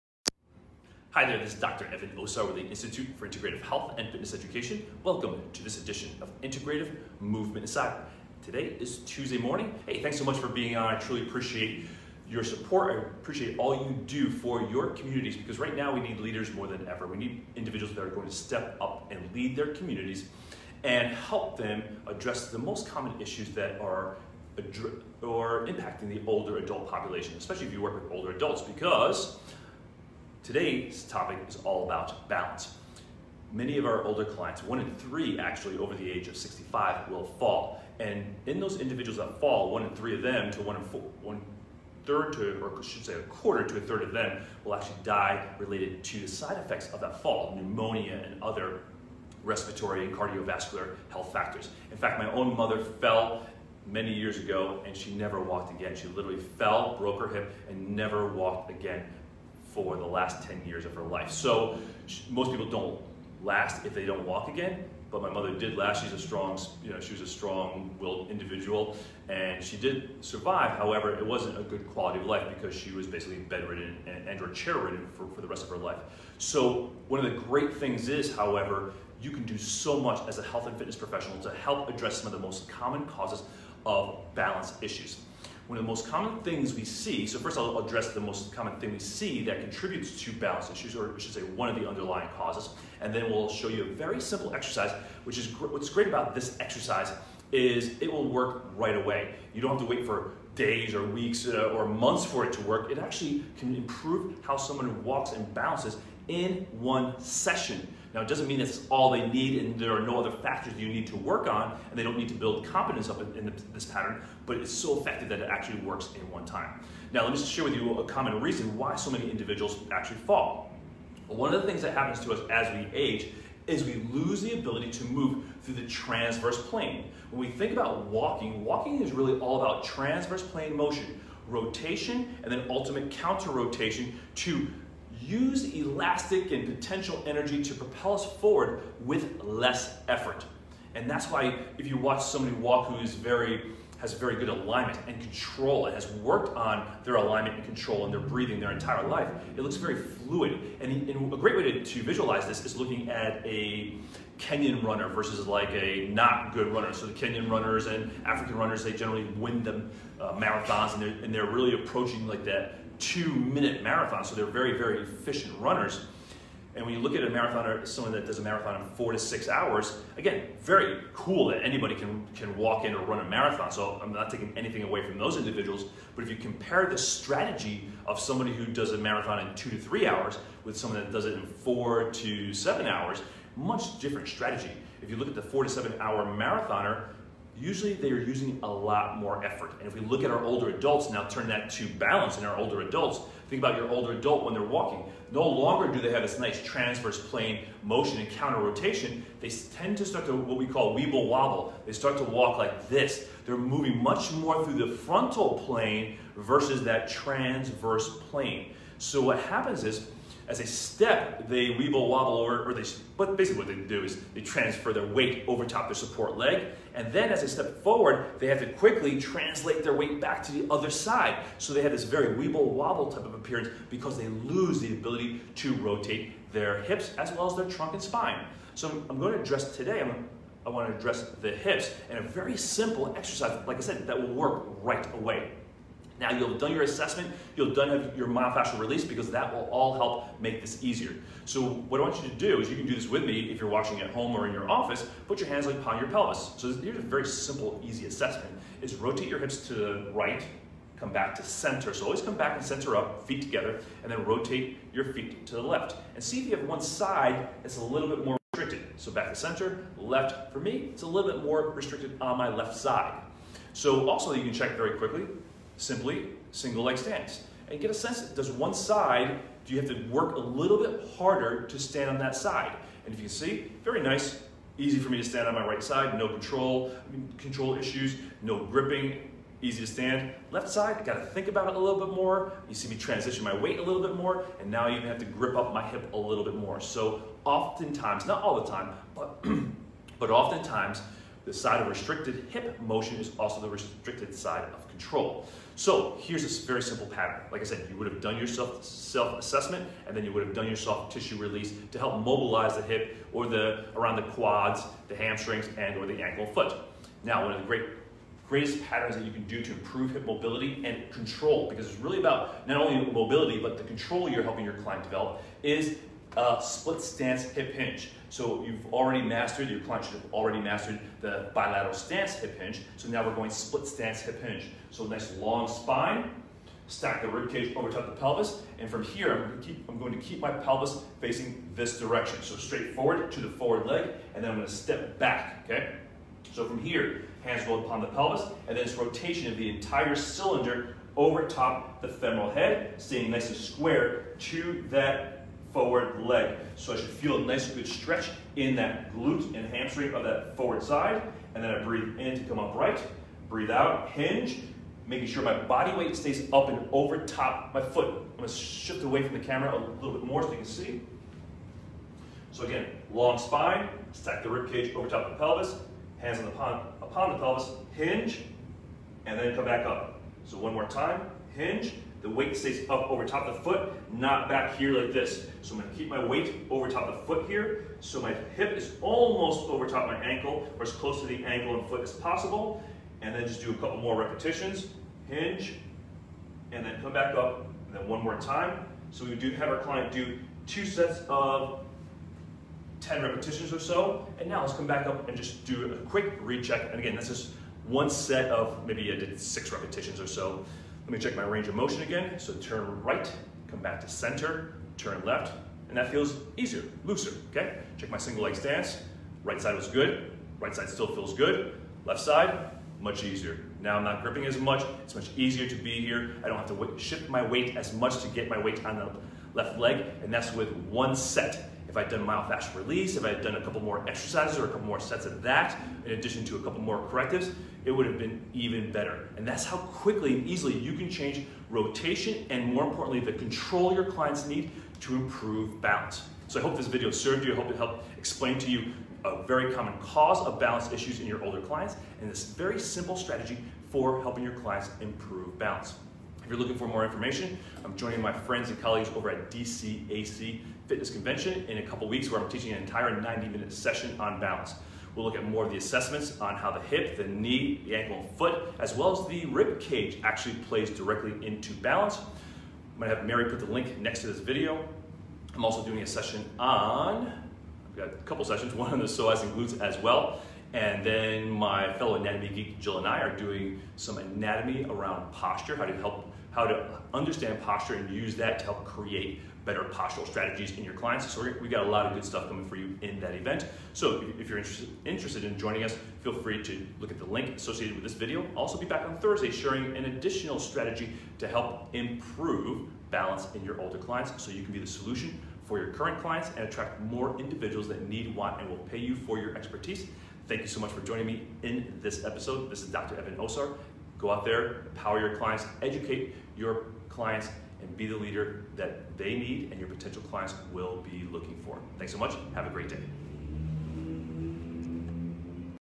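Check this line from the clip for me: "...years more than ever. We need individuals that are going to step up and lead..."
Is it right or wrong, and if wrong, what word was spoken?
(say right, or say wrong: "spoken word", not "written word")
wrong: "leaders", not "years".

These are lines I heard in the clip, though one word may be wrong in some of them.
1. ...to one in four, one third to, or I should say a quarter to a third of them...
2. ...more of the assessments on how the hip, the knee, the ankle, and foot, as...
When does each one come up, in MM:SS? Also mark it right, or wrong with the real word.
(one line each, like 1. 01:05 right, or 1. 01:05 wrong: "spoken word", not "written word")
1. 00:40 right
2. 07:35 right.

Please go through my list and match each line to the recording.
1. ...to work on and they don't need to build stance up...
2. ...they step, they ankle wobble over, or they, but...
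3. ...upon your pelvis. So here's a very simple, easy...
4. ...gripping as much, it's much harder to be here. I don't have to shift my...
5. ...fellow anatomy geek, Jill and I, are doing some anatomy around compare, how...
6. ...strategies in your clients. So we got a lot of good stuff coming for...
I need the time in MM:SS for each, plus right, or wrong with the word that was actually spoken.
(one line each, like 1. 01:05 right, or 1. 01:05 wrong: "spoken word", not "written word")
1. 01:51 wrong: "competence", not "stance"
2. 03:30 wrong: "weeble", not "ankle"
3. 04:05 right
4. 06:54 wrong: "easier", not "harder"
5. 07:51 wrong: "posture", not "compare"
6. 08:00 right.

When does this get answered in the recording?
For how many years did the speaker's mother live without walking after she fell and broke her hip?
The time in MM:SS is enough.
01:00.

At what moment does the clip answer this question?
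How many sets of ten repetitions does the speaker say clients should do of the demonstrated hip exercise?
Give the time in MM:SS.
06:30.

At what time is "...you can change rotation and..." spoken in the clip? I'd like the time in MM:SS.
07:10.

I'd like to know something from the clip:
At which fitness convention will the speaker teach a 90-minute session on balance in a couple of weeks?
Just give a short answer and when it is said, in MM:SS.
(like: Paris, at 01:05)
DCAC Fitness Convention, at 07:29.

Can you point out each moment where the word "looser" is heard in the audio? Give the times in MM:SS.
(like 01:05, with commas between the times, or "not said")
06:47.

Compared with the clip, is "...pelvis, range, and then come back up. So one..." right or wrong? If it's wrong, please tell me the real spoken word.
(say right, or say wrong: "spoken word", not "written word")
wrong: "hinge", not "range".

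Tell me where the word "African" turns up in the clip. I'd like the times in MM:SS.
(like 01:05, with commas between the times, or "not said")
02:38.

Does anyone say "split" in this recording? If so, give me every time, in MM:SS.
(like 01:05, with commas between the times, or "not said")
05:16, 05:23.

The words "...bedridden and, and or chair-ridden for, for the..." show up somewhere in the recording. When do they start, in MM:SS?
01:13.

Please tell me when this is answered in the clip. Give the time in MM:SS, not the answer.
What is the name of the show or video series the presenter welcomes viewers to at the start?
00:06.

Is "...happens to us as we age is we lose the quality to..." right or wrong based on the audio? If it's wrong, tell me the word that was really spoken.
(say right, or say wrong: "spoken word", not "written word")
wrong: "ability", not "quality".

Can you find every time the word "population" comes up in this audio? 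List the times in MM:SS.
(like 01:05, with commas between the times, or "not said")
00:26.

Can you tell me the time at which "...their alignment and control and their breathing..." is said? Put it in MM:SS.
02:27.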